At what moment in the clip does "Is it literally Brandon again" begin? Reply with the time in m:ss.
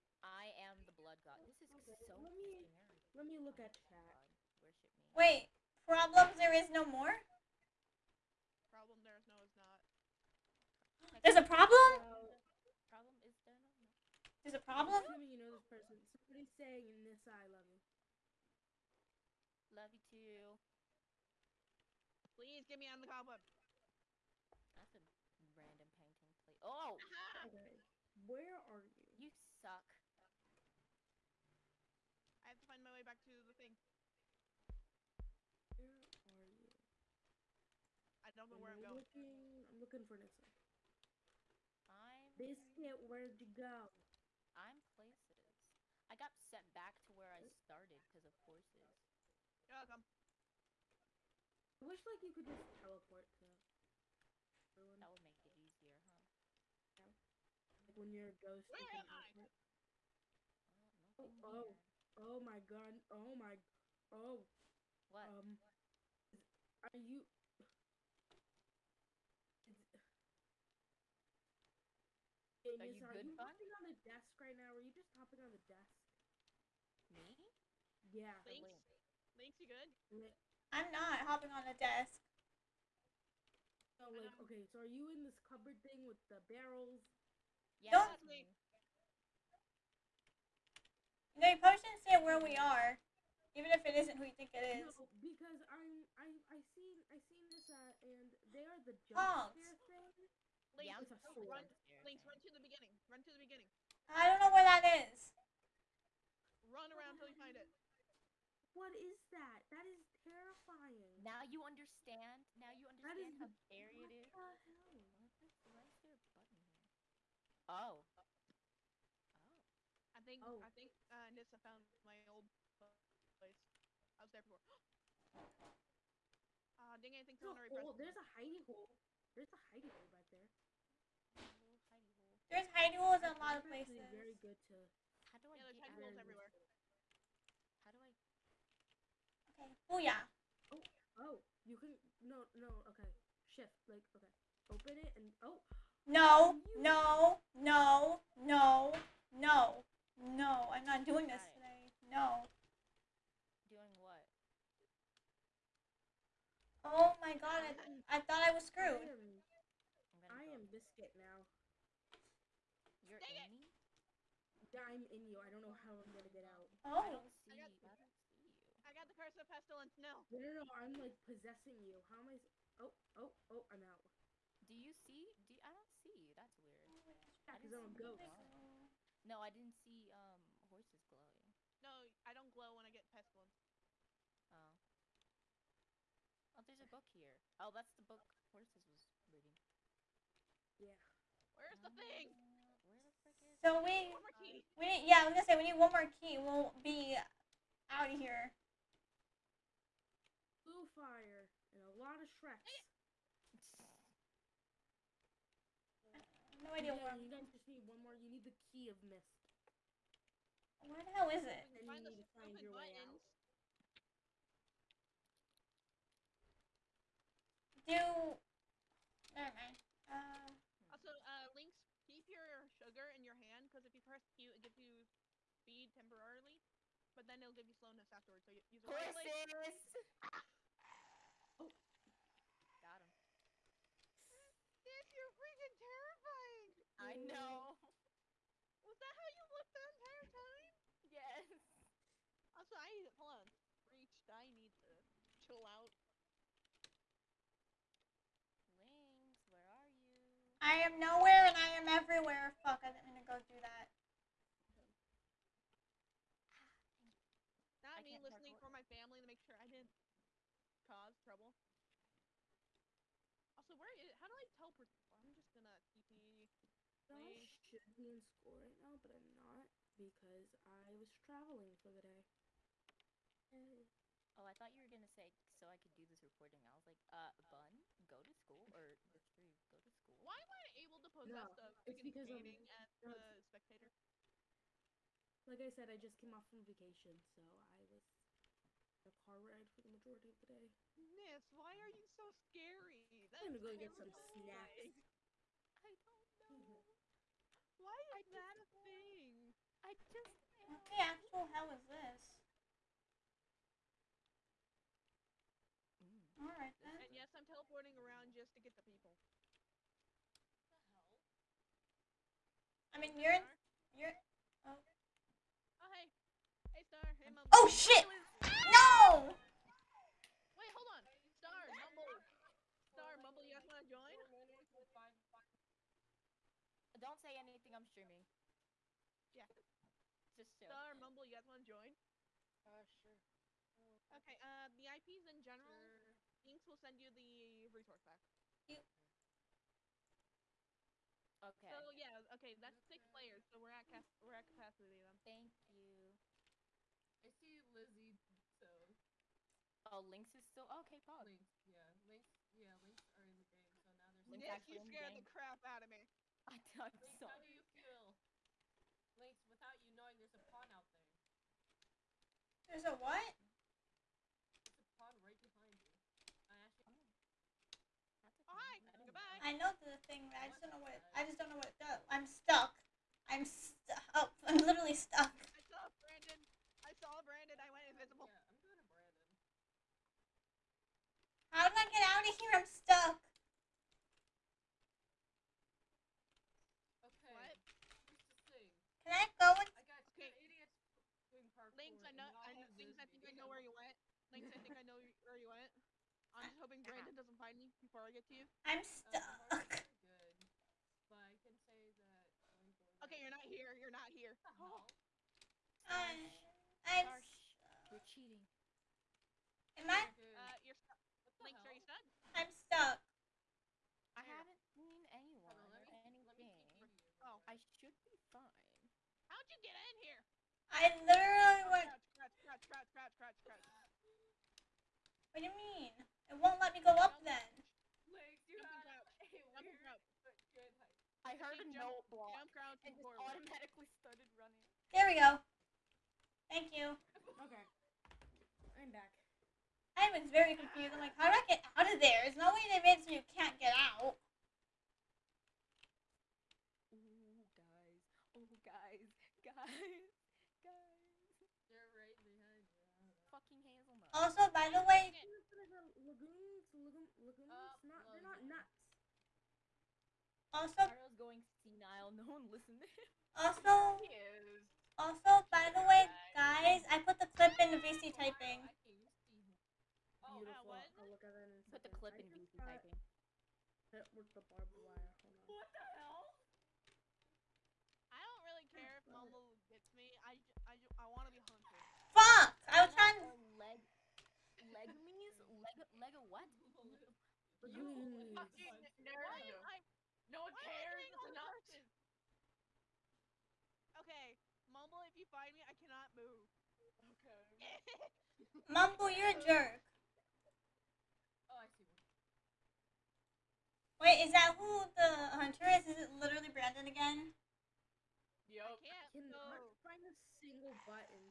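8:25.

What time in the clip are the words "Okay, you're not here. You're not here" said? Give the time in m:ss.
6:43.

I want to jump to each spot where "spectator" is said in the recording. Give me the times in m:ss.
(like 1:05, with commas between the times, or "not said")
4:43.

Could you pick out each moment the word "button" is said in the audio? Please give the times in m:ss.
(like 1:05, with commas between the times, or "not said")
1:56, 3:32.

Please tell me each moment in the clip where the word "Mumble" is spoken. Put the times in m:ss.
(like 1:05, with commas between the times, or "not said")
5:30, 8:14, 8:18.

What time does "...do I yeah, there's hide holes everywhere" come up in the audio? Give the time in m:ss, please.
2:15.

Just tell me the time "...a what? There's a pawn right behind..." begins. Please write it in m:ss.
6:02.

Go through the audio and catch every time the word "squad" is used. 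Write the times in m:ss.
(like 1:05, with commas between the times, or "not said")
not said.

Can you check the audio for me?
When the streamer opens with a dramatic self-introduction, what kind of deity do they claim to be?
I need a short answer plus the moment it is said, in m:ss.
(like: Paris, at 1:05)
the blood god, at 0:00.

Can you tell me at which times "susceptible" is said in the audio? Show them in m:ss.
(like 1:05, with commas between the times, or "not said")
not said.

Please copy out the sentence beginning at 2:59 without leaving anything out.
No, I didn't see um Horsess glowing.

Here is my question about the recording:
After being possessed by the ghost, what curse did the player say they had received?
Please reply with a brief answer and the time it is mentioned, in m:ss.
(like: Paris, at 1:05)
curse of pestilence, at 2:49.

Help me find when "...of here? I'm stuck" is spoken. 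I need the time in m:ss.
6:22.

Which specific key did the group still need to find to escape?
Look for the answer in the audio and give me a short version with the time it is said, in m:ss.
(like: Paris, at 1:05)
the key of mist, at 3:28.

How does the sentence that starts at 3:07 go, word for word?
Oh, that's the book Horsess was reading.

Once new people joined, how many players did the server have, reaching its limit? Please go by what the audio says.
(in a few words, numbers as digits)
6.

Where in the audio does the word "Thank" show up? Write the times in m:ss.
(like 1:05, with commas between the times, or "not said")
5:45, 7:16.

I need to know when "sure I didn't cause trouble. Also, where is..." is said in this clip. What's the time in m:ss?
4:19.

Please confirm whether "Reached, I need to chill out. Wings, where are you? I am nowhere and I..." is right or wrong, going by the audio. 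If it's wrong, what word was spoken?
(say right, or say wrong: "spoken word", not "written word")
right.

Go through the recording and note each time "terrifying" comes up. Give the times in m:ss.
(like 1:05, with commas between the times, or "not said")
1:50, 3:55.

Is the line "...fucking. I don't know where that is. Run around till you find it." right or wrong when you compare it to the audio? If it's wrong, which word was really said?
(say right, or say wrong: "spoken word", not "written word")
wrong: "beginning", not "fucking".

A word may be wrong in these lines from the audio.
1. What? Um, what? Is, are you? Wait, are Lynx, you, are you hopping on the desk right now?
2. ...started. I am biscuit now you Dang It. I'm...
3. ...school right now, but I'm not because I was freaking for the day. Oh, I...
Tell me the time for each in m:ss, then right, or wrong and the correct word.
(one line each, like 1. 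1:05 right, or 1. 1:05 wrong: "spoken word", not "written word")
1. 1:05 wrong: "Nizar", not "Lynx"
2. 2:38 wrong: "screwed", not "started"
3. 4:28 wrong: "traveling", not "freaking".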